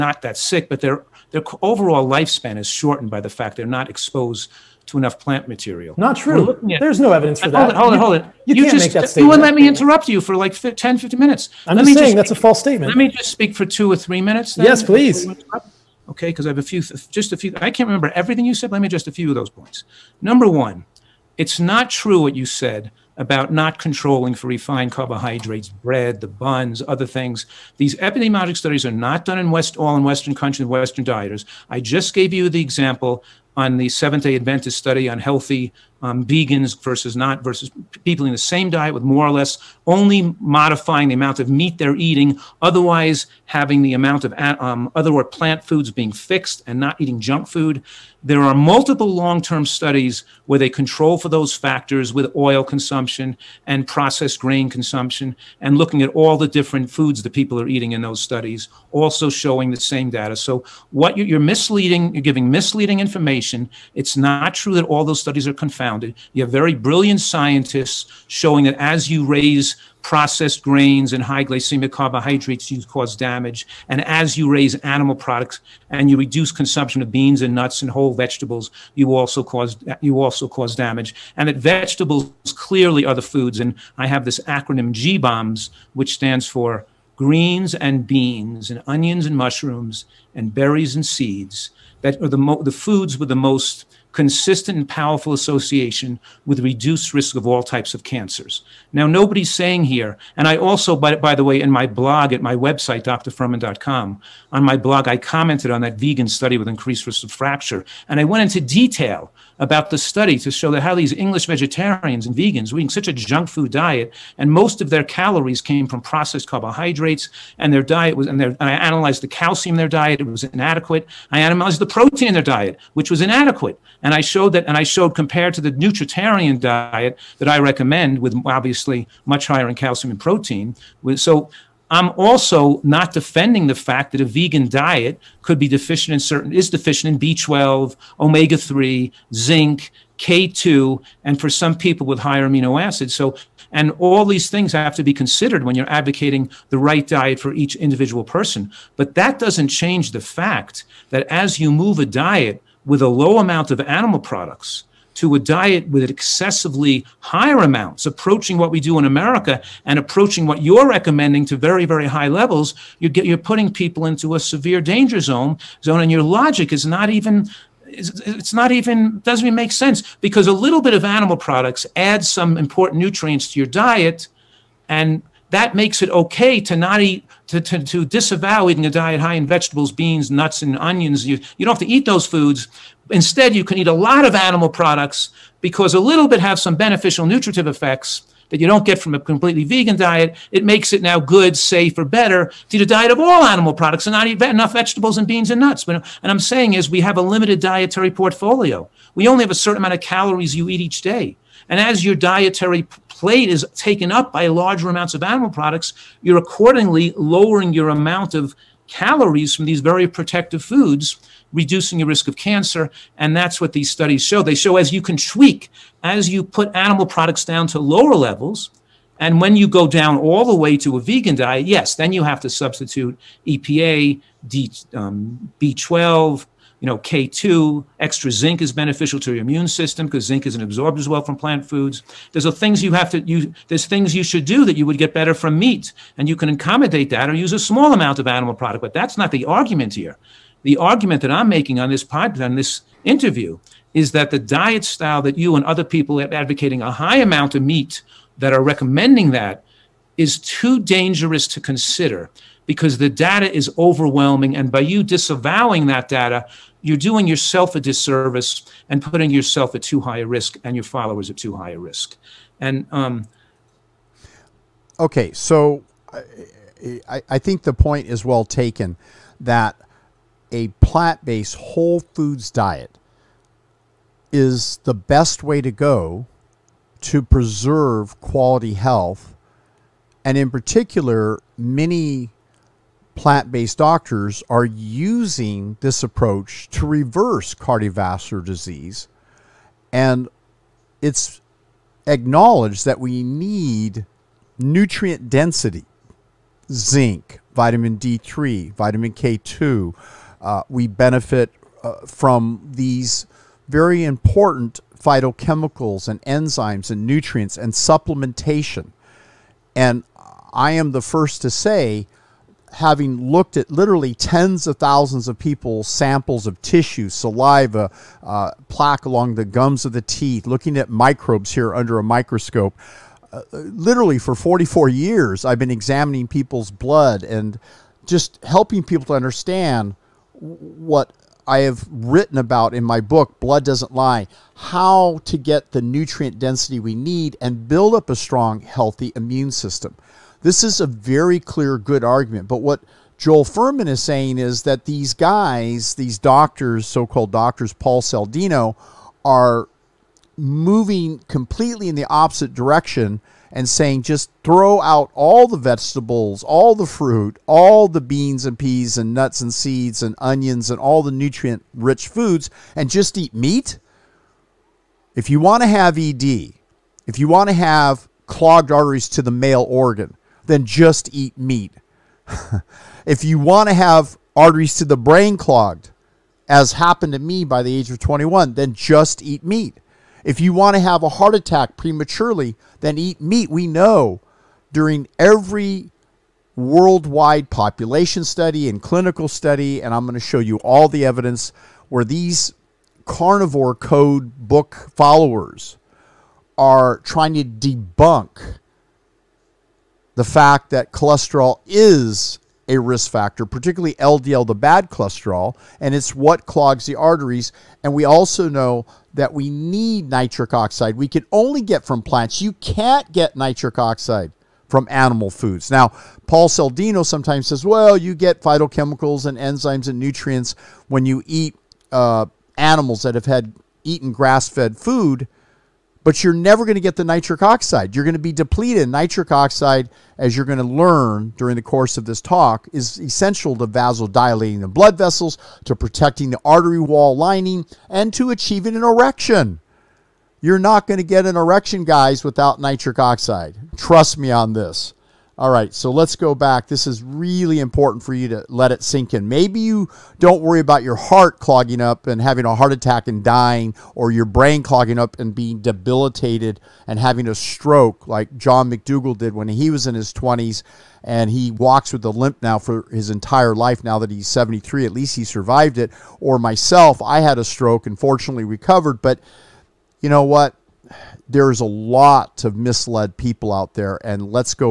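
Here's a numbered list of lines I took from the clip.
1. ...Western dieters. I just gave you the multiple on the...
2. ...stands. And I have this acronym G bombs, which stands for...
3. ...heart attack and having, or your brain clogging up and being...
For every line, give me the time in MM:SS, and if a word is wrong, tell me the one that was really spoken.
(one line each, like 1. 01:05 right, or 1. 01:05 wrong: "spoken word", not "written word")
1. 00:30 wrong: "example", not "multiple"
2. 01:23 wrong: "foods", not "stands"
3. 07:32 wrong: "dying", not "having".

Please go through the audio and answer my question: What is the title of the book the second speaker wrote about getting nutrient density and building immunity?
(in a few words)
Blood Doesn't Lie.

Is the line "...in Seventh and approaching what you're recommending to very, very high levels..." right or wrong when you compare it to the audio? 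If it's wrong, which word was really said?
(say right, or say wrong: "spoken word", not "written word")
wrong: "America", not "Seventh".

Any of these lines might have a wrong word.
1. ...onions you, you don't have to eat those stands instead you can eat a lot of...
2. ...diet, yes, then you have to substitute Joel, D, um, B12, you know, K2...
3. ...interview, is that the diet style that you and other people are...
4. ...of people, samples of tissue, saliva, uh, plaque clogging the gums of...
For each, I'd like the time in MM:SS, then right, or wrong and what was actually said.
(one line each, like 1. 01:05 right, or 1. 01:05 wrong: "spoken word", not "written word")
1. 03:00 wrong: "foods", not "stands"
2. 03:41 wrong: "EPA", not "Joel"
3. 04:03 right
4. 05:15 wrong: "along", not "clogging".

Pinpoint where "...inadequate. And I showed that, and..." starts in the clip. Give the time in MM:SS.
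02:03.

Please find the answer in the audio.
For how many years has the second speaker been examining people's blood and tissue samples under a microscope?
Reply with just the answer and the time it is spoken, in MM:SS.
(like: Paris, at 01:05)
44, at 05:24.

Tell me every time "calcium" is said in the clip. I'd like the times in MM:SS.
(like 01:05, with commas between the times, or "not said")
01:59, 02:09.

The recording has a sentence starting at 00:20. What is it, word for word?
Number one, it's not true what you said about not controlling for refined carbohydrates, bread, the buns, other things.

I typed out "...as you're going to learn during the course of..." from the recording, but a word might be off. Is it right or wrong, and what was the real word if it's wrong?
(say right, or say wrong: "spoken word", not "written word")
right.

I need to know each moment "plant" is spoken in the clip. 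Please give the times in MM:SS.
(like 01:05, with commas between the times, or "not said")
00:05, 00:45, 03:51, 04:30, 04:43, 06:52.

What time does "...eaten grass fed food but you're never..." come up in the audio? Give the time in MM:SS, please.
07:03.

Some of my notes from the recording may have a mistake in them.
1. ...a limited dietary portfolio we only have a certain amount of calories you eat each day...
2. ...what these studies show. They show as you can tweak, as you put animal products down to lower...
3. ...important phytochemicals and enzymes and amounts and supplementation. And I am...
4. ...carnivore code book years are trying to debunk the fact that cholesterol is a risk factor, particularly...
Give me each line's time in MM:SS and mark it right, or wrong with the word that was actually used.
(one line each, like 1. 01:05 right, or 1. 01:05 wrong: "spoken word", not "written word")
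1. 03:17 right
2. 03:33 right
3. 05:04 wrong: "nutrients", not "amounts"
4. 06:33 wrong: "followers", not "years".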